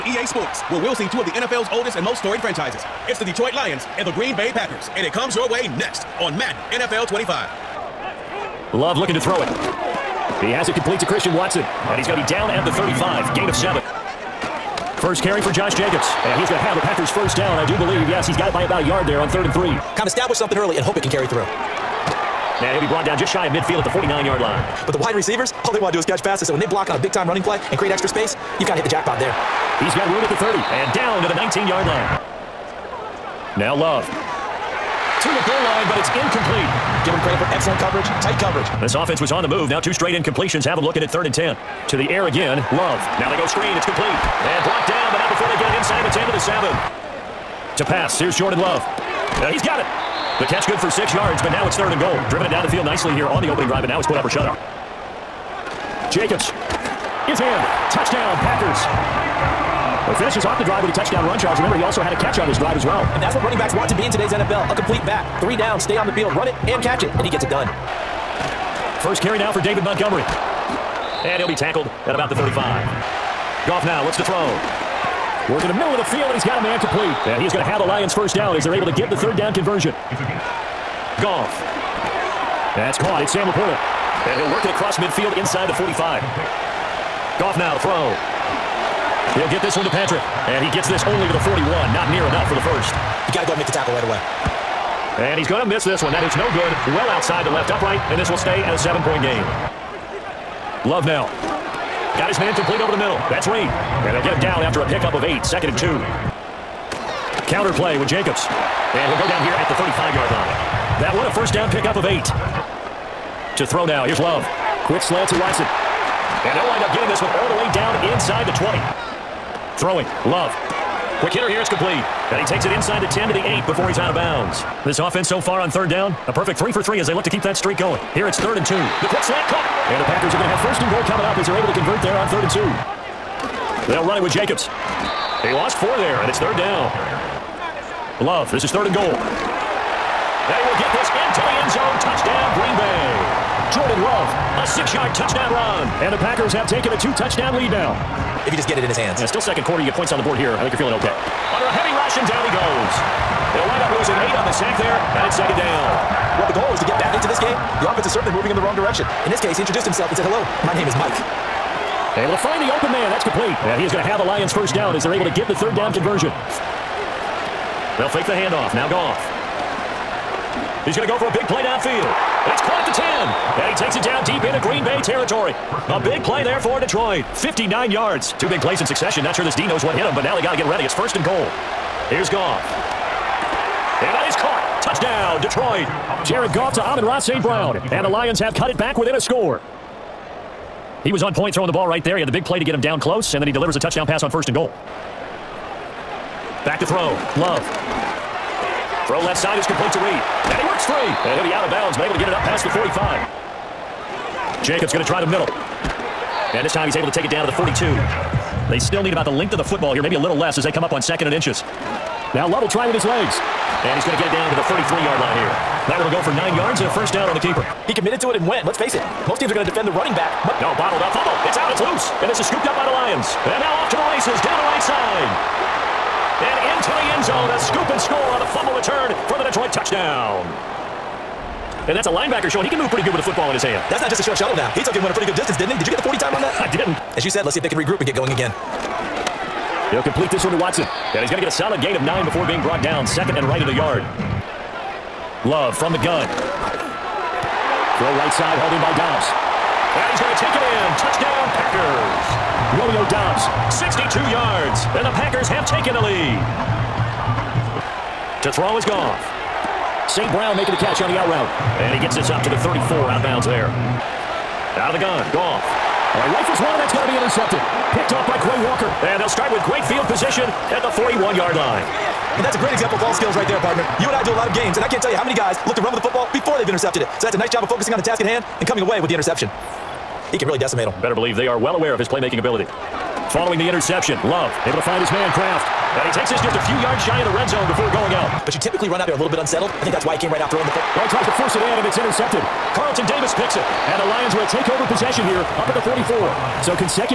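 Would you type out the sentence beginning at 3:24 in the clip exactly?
Jacobs going to try the middle.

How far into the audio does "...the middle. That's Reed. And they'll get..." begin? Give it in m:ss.
1:42.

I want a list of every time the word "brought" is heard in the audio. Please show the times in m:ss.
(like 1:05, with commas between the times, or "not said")
0:22, 0:44, 4:02.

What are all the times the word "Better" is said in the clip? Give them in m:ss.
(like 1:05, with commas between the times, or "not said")
4:41.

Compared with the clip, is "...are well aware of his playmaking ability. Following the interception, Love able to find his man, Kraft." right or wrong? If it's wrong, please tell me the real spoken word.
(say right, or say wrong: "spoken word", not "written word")
right.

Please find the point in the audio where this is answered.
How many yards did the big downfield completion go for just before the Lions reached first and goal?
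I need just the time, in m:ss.
2:57.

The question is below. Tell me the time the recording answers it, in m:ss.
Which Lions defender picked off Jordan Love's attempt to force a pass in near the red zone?
4:52.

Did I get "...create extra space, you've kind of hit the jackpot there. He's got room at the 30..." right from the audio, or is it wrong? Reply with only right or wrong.
right.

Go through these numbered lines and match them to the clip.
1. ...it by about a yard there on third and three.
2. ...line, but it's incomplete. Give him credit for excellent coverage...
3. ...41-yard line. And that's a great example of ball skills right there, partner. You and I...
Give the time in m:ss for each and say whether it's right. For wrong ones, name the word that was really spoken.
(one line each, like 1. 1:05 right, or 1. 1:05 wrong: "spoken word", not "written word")
1. 0:18 right
2. 0:35 right
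3. 4:30 right.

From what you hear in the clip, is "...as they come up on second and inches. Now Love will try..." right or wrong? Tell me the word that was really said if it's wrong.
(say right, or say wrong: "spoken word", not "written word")
right.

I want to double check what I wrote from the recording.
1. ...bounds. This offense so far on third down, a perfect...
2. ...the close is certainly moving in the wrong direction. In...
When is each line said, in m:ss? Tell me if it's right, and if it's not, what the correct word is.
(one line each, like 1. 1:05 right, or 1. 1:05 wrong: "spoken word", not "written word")
1. 2:04 right
2. 2:37 wrong: "offense", not "close".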